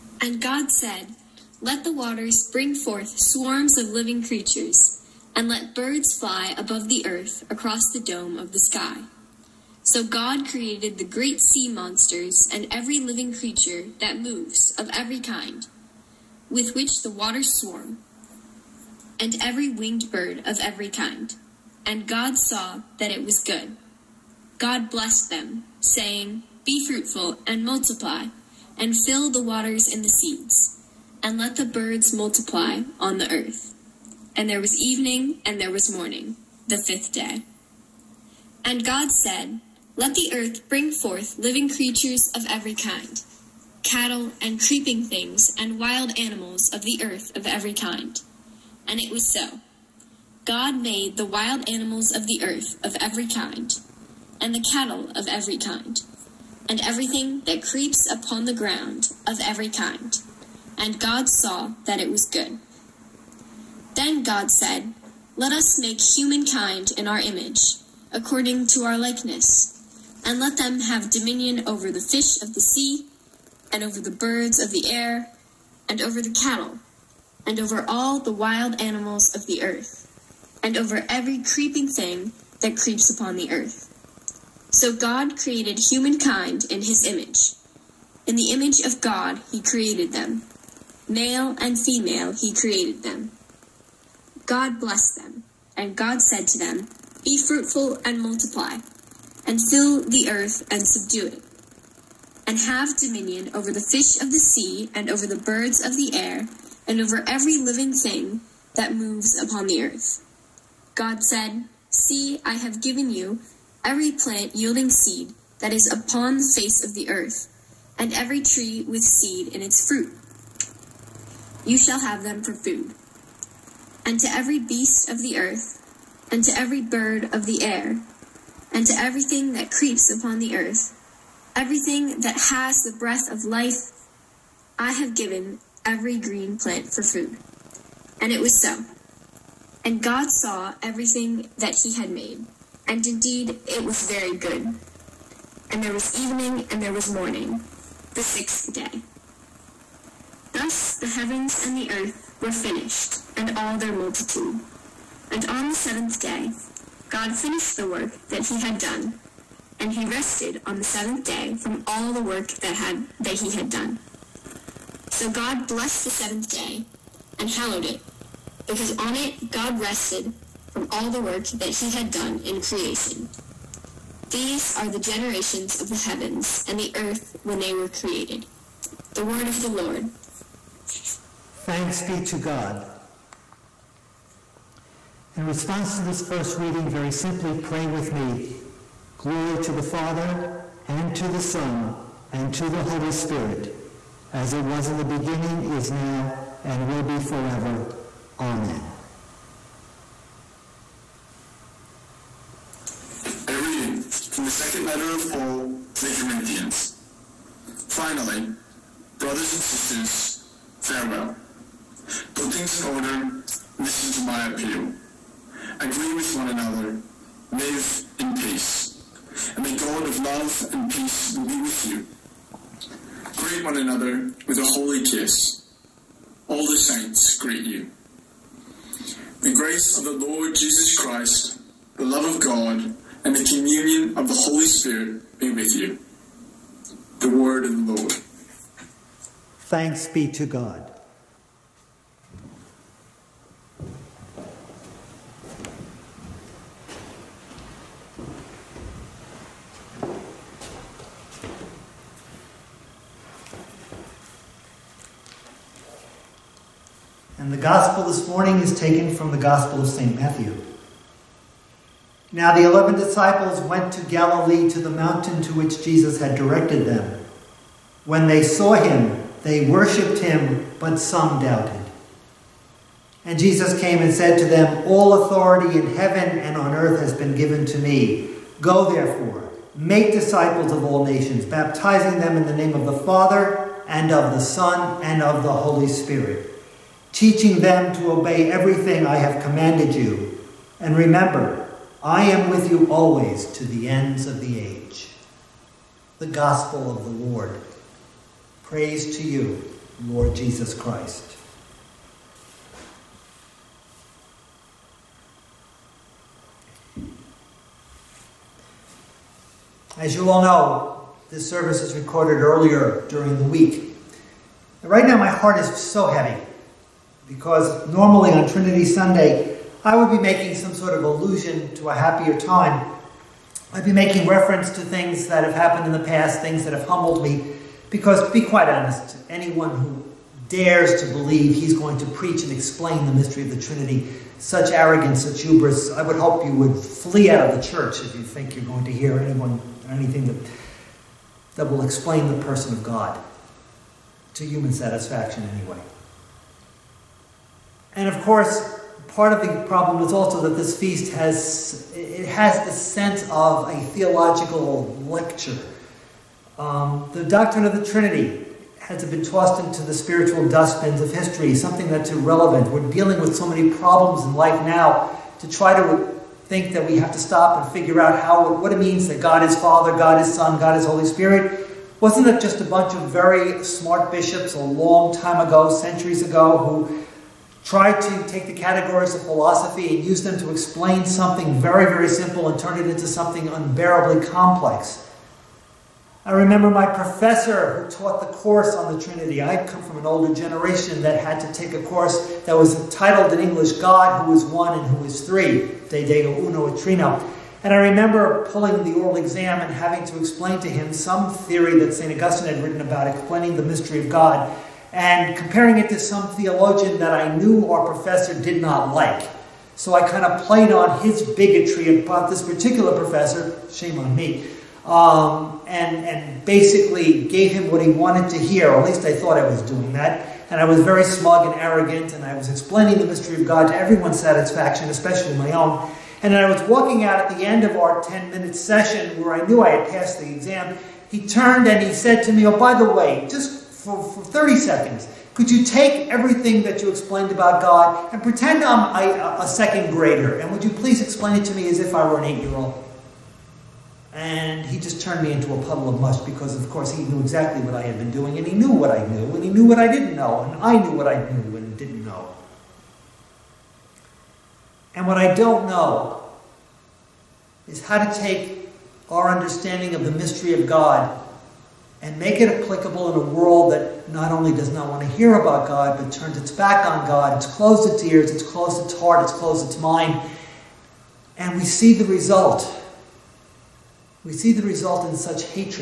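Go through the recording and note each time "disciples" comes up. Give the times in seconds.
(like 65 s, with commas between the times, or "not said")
262 s, 280 s.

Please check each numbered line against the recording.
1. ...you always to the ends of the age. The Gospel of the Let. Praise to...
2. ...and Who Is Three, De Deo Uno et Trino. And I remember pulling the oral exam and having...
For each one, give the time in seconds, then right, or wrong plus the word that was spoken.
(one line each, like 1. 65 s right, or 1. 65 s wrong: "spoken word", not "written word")
1. 292 s wrong: "Lord", not "Let"
2. 394 s right.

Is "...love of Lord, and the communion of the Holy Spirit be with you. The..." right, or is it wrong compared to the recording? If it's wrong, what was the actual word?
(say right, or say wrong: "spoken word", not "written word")
wrong: "God", not "Lord".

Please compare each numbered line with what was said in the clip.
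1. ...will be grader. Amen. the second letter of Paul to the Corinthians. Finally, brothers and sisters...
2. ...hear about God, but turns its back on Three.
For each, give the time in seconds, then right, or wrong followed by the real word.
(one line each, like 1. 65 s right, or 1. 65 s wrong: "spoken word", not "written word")
1. 196 s wrong: "forever", not "grader"
2. 465 s wrong: "God", not "Three".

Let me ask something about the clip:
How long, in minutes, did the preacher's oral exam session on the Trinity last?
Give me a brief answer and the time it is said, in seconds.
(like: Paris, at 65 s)
10 minutes, at 428 s.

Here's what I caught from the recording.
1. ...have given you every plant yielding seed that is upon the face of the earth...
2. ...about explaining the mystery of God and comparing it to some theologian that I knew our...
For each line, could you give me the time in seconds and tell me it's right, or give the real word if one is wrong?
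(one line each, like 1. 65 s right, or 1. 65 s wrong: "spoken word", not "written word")
1. 112 s right
2. 402 s right.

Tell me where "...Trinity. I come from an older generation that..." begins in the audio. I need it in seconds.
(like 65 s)
388 s.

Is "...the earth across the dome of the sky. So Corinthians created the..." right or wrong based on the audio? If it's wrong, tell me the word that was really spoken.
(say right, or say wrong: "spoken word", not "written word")
wrong: "God", not "Corinthians".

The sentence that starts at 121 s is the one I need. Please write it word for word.
You shall have them for food.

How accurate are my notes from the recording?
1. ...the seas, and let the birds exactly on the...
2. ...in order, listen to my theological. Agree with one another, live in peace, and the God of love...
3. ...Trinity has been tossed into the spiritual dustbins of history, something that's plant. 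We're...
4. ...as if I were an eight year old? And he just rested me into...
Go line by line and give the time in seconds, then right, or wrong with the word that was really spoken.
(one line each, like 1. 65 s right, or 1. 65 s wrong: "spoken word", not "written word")
1. 29 s wrong: "multiply", not "exactly"
2. 212 s wrong: "appeal", not "theological"
3. 357 s wrong: "irrelevant", not "plant"
4. 441 s wrong: "turned", not "rested".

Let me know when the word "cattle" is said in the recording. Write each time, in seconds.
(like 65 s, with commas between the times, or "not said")
43 s, 54 s, 76 s.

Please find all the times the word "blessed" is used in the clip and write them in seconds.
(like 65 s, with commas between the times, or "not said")
24 s, 94 s, 165 s.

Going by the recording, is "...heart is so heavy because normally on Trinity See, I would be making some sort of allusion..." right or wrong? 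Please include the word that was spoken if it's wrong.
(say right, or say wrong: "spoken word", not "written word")
wrong: "Sunday", not "See".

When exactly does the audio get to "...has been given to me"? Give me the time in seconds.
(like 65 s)
276 s.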